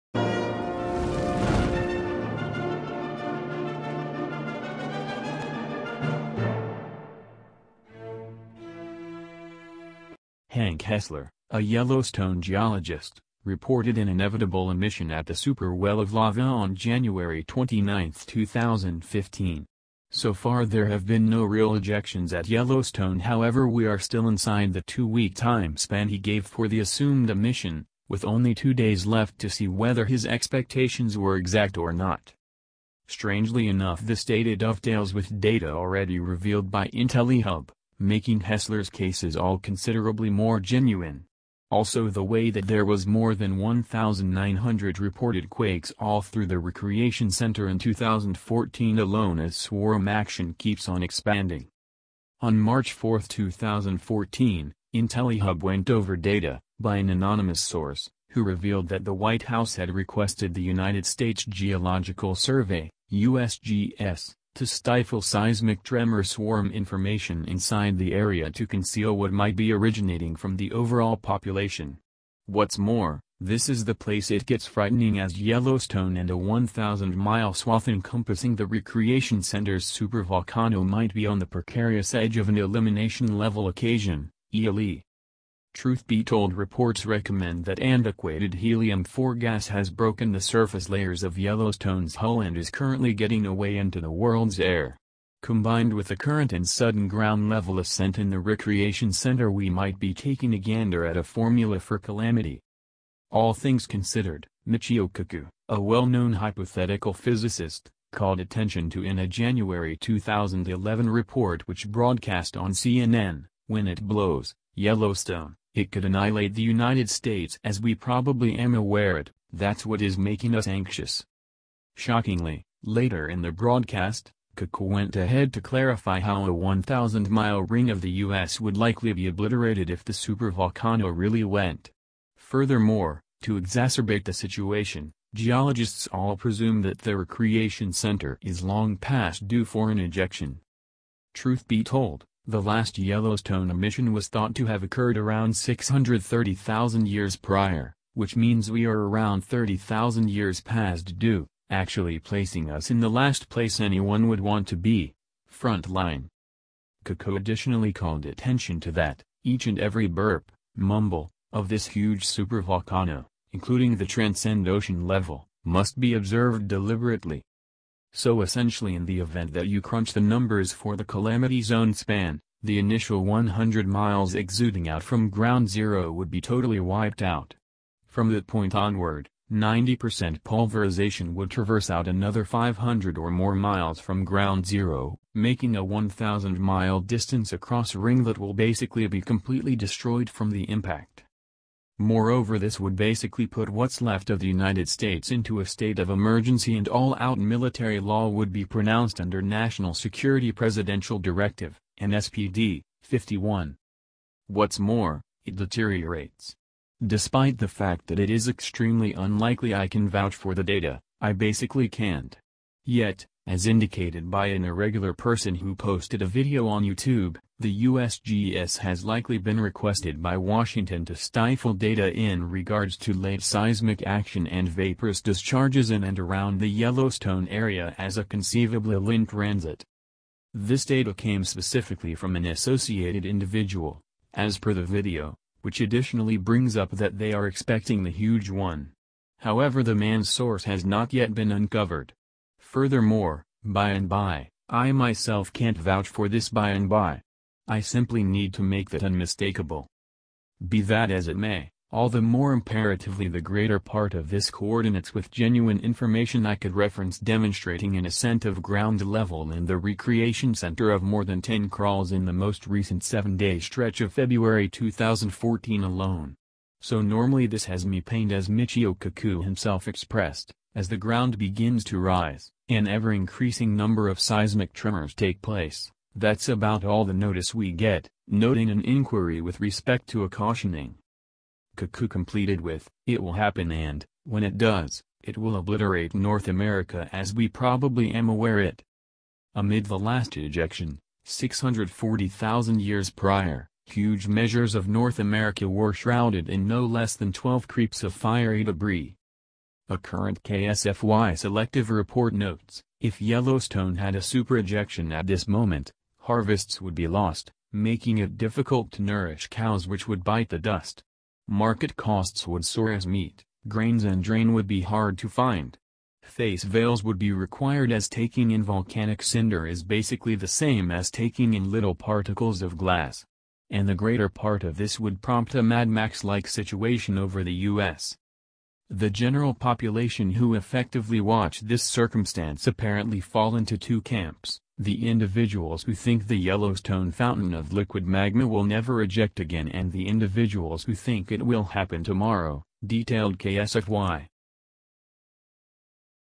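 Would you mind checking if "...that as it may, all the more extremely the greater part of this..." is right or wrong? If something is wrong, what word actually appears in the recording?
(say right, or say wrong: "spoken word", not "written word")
wrong: "imperatively", not "extremely".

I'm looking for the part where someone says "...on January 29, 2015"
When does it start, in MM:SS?
00:16.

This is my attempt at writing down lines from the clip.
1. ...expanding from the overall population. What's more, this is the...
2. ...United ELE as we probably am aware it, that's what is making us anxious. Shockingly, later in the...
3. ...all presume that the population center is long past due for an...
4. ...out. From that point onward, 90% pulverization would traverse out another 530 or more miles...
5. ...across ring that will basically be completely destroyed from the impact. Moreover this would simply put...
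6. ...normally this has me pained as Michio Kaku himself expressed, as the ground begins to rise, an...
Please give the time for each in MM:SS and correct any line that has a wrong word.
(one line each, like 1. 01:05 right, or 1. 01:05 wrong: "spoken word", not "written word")
1. 01:09 wrong: "originating", not "expanding"
2. 01:56 wrong: "States", not "ELE"
3. 02:16 wrong: "recreation", not "population"
4. 02:57 wrong: "500", not "530"
5. 03:07 wrong: "basically", not "simply"
6. 04:27 right.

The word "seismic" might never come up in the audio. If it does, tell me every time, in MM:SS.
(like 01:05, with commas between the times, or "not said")
01:05, 03:43, 04:34.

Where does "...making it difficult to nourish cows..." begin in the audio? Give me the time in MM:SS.
05:07.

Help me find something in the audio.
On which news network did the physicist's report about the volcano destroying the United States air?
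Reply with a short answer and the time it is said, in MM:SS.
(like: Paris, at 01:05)
CNN, at 01:52.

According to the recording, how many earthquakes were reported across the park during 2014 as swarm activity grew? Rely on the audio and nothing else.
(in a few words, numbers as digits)
more than 1,900.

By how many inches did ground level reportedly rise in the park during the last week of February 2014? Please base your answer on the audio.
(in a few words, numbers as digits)
more than 10.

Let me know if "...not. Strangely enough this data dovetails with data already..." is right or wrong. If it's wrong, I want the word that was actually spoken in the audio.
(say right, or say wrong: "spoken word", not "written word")
right.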